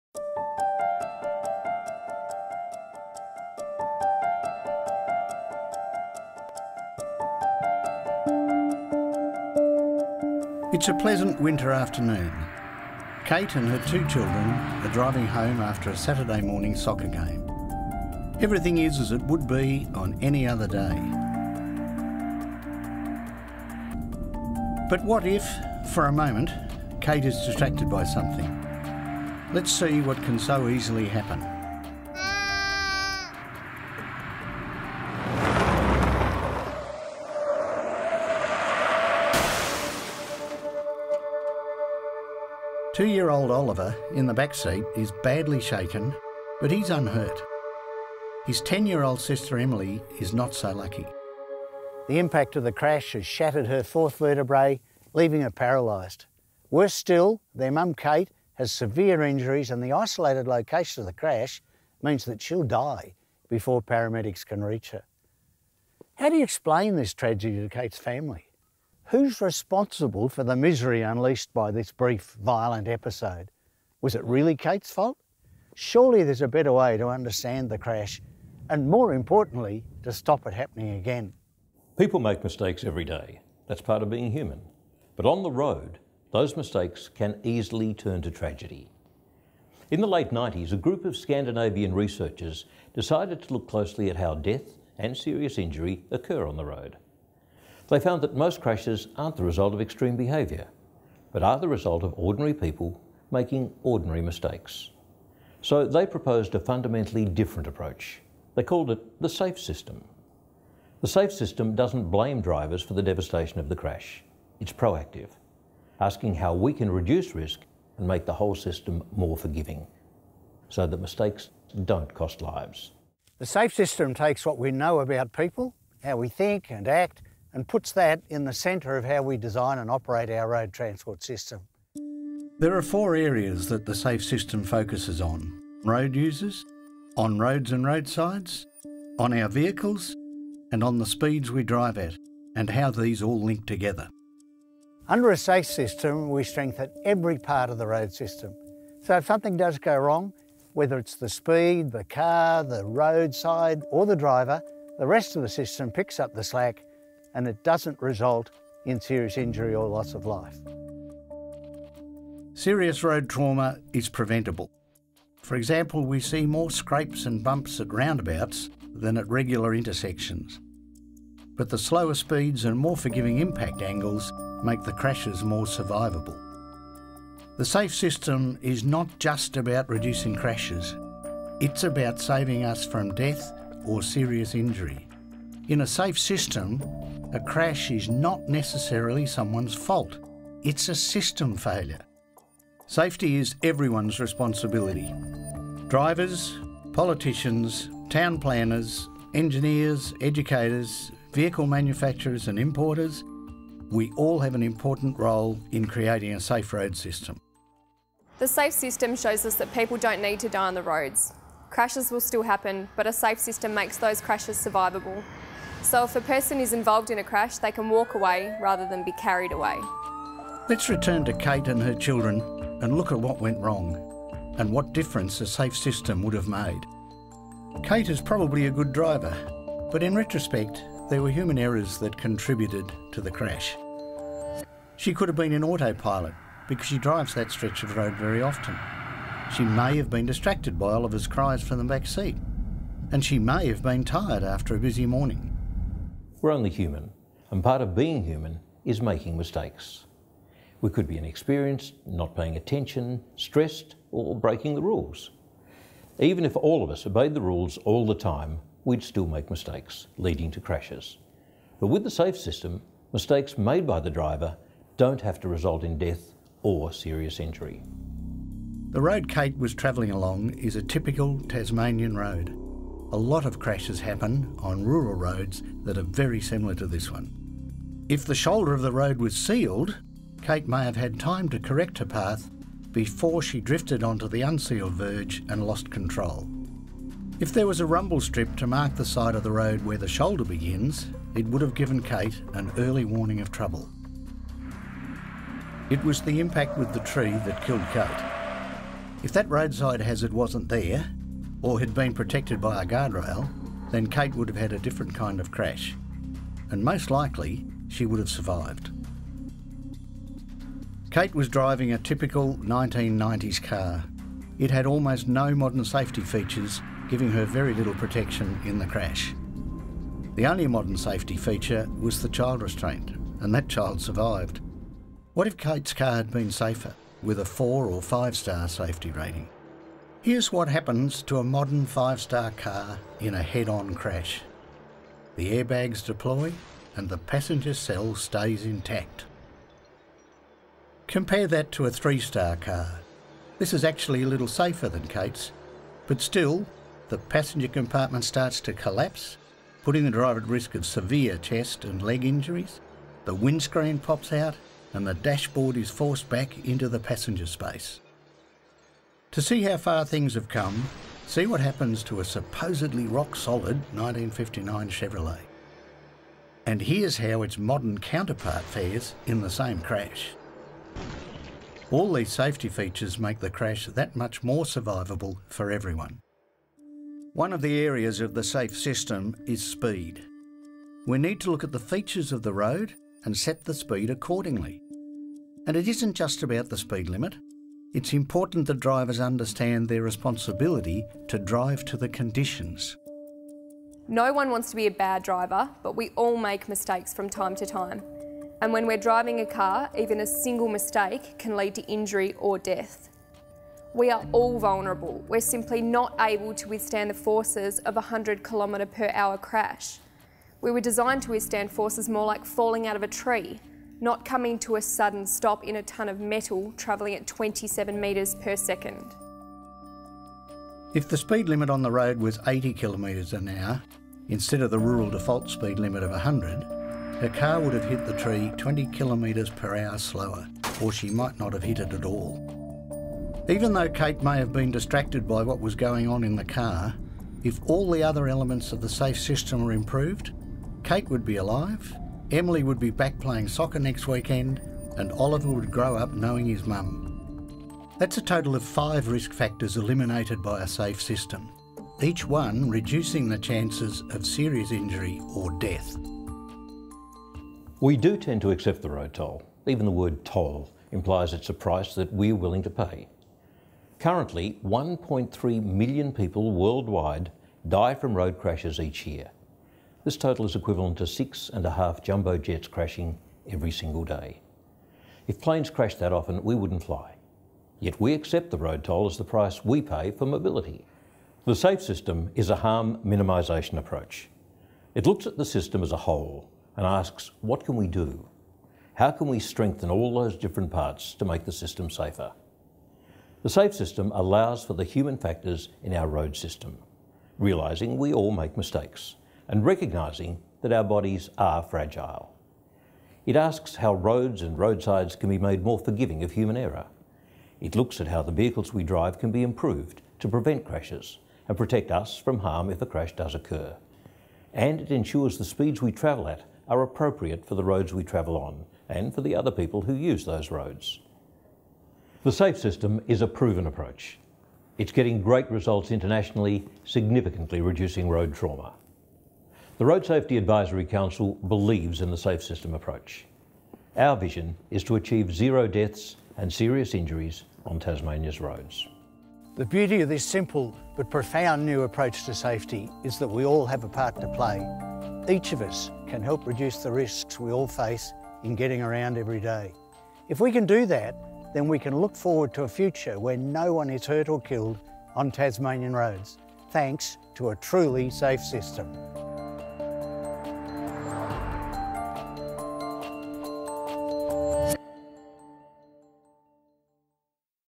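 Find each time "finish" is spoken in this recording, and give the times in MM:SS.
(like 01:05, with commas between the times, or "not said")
not said.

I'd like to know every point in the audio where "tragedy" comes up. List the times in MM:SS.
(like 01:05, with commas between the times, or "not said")
01:07, 01:28.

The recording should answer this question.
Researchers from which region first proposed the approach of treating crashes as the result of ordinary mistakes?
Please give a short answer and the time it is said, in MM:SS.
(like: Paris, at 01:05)
Scandinavian, at 01:31.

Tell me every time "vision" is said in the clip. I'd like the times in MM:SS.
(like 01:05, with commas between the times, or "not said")
08:54.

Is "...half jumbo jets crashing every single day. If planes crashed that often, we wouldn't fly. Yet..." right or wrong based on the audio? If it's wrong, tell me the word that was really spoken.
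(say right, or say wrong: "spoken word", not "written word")
right.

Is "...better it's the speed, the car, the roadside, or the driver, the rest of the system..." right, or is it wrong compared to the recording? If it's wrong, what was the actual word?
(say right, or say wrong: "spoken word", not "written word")
wrong: "whether", not "better".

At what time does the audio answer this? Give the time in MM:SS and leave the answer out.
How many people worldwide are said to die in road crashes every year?
07:44.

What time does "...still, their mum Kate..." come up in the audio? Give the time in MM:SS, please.
00:56.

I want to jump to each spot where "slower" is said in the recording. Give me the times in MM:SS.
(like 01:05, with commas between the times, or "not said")
02:51, 07:09.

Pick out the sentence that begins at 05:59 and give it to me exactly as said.
To see how far things have come, see what happens to a supposedly rock solid 1959 Chevrolet.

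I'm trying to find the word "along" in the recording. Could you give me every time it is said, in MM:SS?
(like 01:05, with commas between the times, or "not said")
04:30.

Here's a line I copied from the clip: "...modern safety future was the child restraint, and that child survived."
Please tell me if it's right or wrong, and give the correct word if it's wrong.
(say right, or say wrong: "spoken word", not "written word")
wrong: "feature", not "future".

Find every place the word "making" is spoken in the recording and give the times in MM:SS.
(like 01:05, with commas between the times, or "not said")
01:43, 04:08.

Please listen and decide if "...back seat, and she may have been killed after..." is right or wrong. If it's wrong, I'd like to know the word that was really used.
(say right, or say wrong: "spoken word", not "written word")
wrong: "tired", not "killed".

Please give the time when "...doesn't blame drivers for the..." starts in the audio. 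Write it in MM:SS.
01:51.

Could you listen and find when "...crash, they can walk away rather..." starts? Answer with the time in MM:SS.
03:37.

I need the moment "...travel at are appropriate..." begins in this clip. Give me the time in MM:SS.
08:35.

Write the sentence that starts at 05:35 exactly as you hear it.
The airbags deploy and the passenger cell stays intact.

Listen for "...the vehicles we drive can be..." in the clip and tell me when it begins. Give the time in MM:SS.
08:28.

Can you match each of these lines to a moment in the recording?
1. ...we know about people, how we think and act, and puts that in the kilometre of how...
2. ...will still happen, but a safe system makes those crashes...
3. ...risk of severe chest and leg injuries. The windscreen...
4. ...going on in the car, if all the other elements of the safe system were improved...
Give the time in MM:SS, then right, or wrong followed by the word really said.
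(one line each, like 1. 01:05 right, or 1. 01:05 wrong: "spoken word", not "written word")
1. 02:04 wrong: "centre", not "kilometre"
2. 03:32 right
3. 05:50 right
4. 07:15 right.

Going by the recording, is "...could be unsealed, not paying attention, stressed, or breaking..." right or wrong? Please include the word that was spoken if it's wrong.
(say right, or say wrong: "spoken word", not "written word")
wrong: "inexperienced", not "unsealed".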